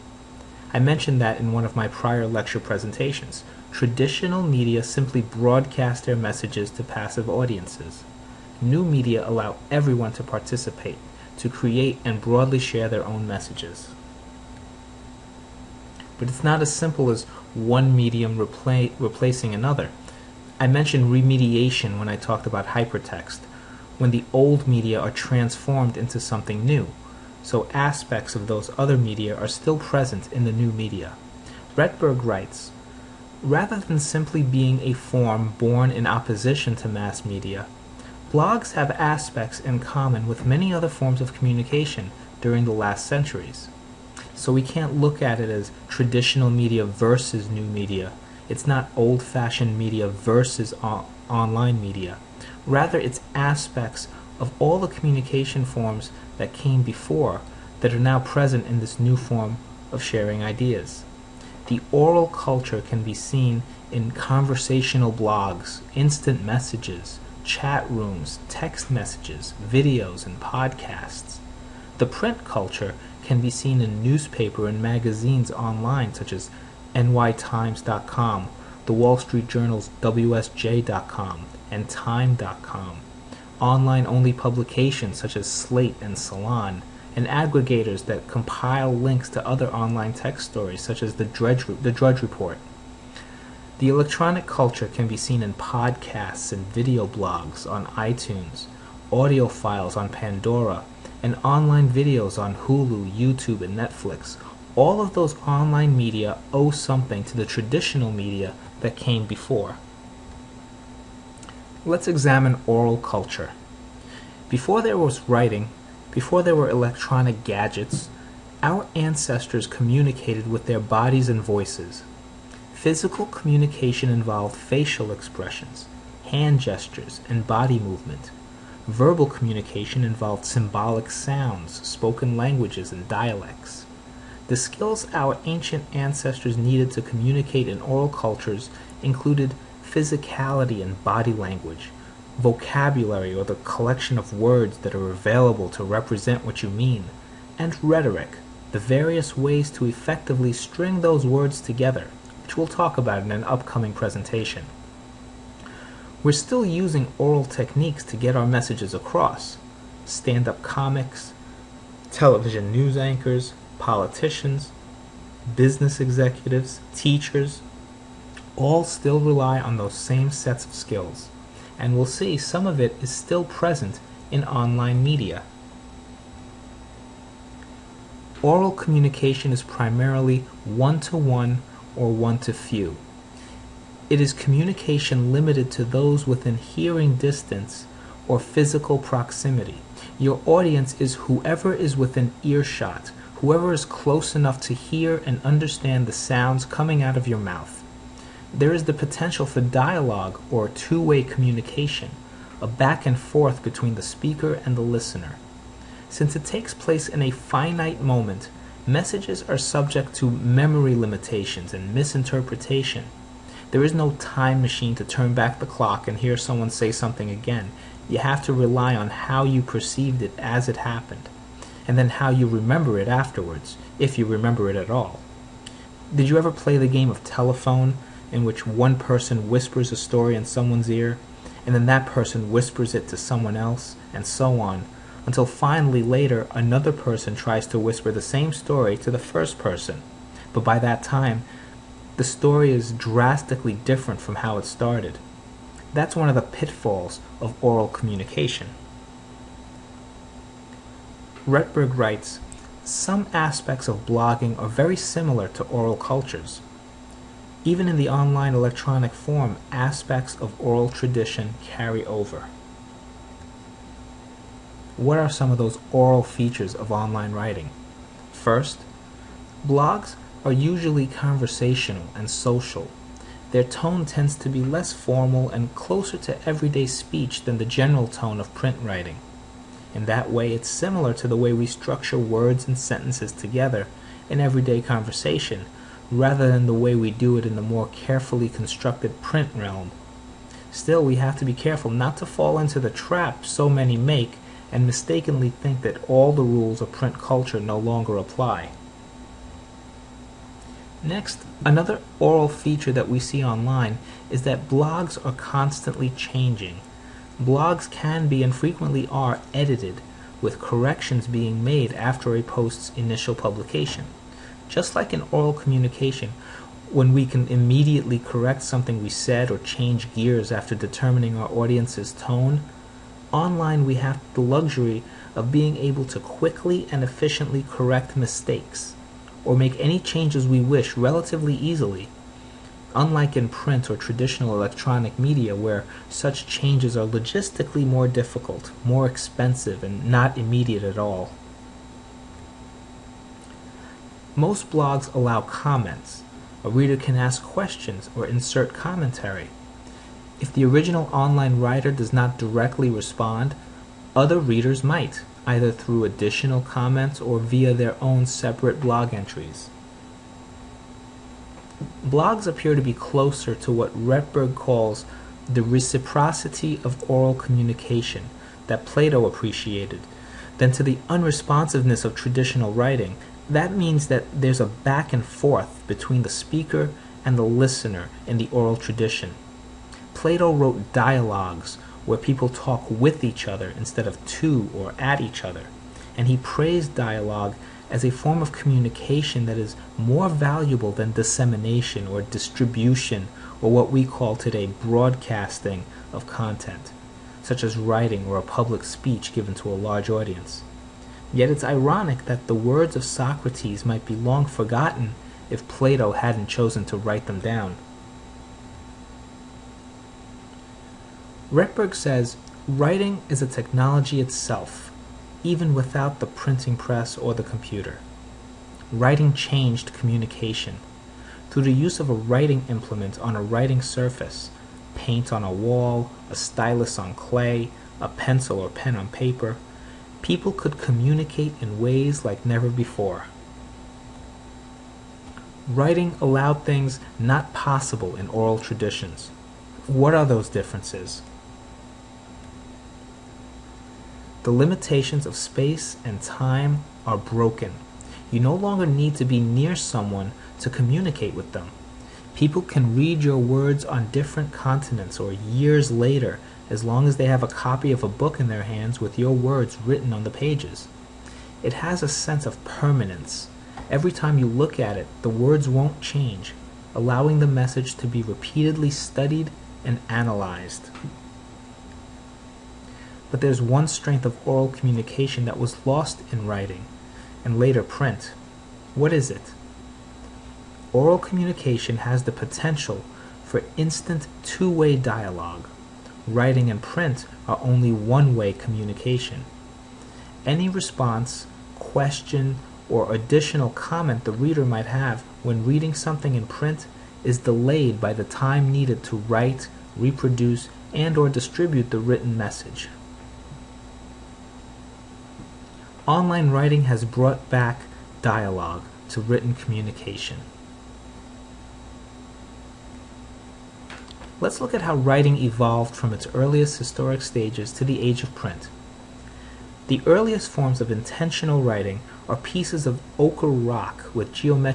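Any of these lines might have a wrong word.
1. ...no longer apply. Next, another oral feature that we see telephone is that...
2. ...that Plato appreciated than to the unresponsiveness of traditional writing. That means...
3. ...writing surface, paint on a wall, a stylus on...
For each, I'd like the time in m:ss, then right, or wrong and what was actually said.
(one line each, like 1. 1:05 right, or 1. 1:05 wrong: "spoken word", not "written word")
1. 4:57 wrong: "online", not "telephone"
2. 6:08 right
3. 7:03 right.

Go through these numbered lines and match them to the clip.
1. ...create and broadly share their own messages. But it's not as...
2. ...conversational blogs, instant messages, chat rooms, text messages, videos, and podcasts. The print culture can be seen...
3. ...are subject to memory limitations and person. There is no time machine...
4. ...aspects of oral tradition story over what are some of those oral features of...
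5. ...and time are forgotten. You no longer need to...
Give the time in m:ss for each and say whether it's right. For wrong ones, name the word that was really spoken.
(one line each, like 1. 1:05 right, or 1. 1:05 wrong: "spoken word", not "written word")
1. 0:11 right
2. 1:04 right
3. 3:29 wrong: "misinterpretation", not "person"
4. 4:19 wrong: "carry", not "story"
5. 7:26 wrong: "broken", not "forgotten".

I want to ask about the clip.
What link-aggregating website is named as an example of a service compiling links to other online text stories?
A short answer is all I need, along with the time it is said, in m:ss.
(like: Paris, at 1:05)
Drudge Report, at 1:31.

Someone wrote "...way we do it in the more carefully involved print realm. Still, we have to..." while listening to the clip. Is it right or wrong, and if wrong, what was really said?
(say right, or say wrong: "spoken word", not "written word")
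wrong: "constructed", not "involved".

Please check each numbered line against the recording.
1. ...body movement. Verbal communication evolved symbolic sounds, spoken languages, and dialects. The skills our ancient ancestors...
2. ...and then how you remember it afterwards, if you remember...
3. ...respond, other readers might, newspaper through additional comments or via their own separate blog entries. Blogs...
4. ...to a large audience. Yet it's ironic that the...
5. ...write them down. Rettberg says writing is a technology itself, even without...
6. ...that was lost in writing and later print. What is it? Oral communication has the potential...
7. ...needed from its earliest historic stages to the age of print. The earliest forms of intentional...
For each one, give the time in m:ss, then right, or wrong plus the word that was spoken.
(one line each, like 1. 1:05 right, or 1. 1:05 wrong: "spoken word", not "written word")
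1. 2:07 wrong: "involved", not "evolved"
2. 3:41 right
3. 5:52 wrong: "either", not "newspaper"
4. 6:39 right
5. 6:46 right
6. 7:55 right
7. 8:35 wrong: "evolved", not "needed".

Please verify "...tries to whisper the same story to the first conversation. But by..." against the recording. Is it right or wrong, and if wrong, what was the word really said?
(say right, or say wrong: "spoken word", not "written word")
wrong: "person", not "conversation".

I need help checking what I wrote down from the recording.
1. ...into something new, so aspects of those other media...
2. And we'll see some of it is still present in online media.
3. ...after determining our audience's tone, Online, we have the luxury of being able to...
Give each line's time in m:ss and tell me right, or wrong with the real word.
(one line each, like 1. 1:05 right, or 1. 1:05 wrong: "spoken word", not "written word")
1. 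0:25 right
2. 2:51 right
3. 5:20 right.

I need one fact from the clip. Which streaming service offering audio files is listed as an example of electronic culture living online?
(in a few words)
Pandora.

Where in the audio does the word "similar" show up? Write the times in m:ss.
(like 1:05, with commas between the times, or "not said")
4:14, 4:40.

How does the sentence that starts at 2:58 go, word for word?
Oral communication is primarily one-to-one one to one or one to few.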